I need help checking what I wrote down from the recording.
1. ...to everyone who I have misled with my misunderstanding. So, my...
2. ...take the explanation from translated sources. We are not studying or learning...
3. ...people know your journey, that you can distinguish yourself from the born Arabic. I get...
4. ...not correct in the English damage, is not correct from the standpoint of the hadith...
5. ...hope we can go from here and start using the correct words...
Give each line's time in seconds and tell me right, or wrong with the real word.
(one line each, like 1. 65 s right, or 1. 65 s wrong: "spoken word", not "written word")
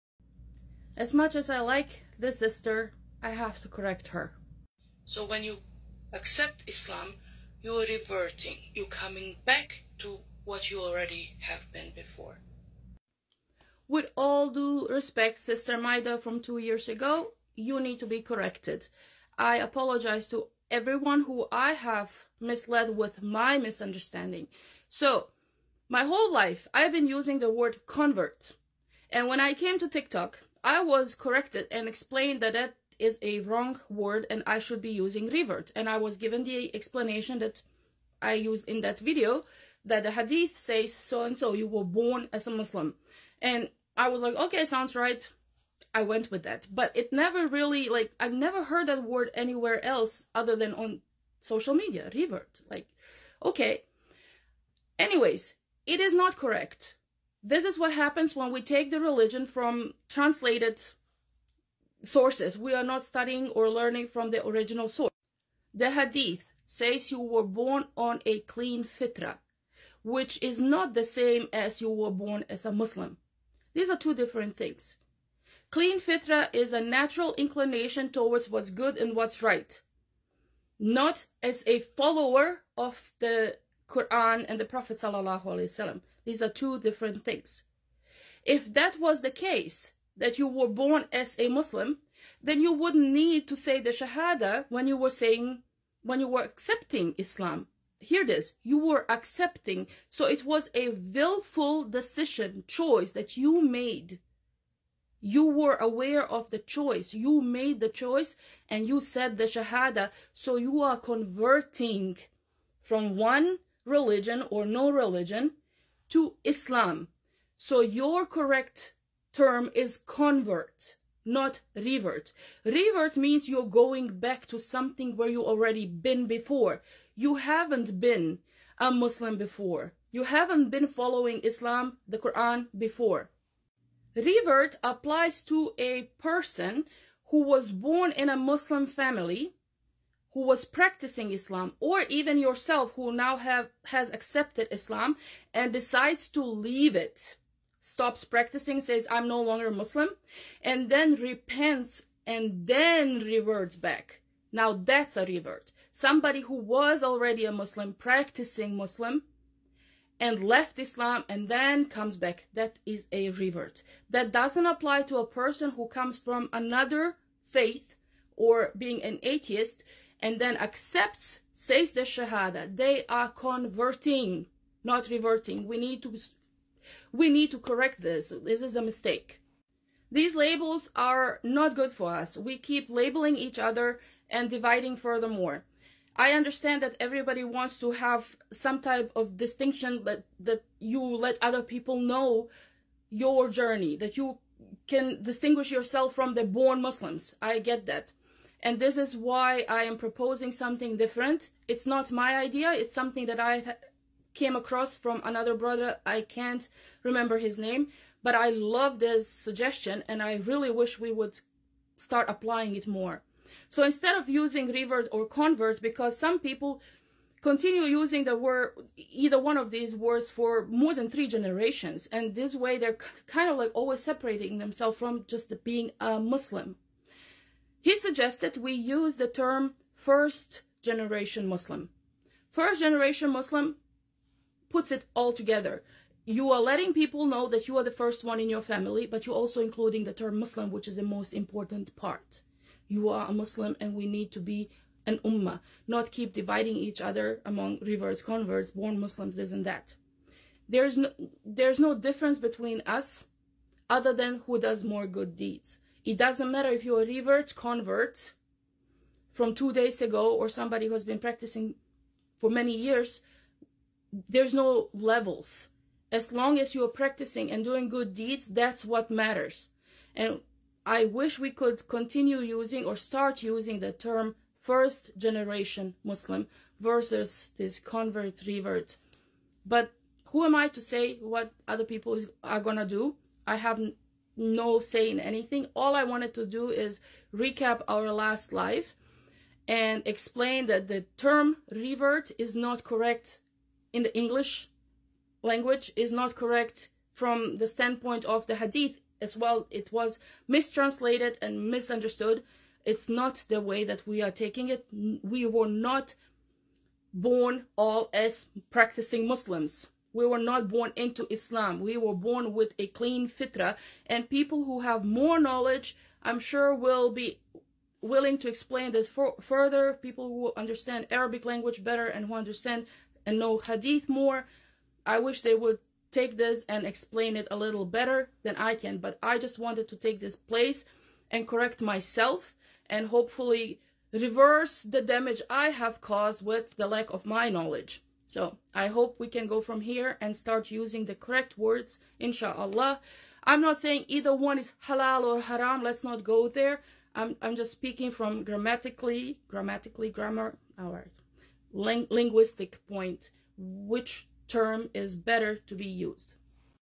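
1. 20 s right
2. 58 s wrong: "religion", not "explanation"
3. 191 s wrong: "Muslims", not "Arabic"
4. 292 s wrong: "language", not "damage"
5. 338 s right.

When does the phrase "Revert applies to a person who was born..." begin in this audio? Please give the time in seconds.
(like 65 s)
134 s.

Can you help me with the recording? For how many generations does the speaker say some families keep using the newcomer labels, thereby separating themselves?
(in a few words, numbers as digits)
3.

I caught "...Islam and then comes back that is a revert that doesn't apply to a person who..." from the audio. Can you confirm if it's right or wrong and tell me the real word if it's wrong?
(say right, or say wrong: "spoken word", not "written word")
right.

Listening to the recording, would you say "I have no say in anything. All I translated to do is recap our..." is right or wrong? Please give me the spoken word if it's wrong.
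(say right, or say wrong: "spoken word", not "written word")
wrong: "wanted", not "translated".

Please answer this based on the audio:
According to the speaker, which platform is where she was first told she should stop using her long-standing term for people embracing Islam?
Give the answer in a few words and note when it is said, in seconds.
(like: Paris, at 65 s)
TikTok, at 29 s.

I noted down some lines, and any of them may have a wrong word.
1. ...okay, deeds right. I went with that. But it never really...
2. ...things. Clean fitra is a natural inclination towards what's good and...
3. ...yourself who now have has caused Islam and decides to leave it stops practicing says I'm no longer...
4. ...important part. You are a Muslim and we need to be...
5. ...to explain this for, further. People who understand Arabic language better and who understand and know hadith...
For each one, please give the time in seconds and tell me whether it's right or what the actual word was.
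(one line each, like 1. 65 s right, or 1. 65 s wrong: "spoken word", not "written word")
1. 44 s wrong: "sounds", not "deeds"
2. 74 s right
3. 142 s wrong: "accepted", not "caused"
4. 241 s right
5. 318 s right.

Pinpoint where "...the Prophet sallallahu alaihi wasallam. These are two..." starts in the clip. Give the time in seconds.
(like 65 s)
84 s.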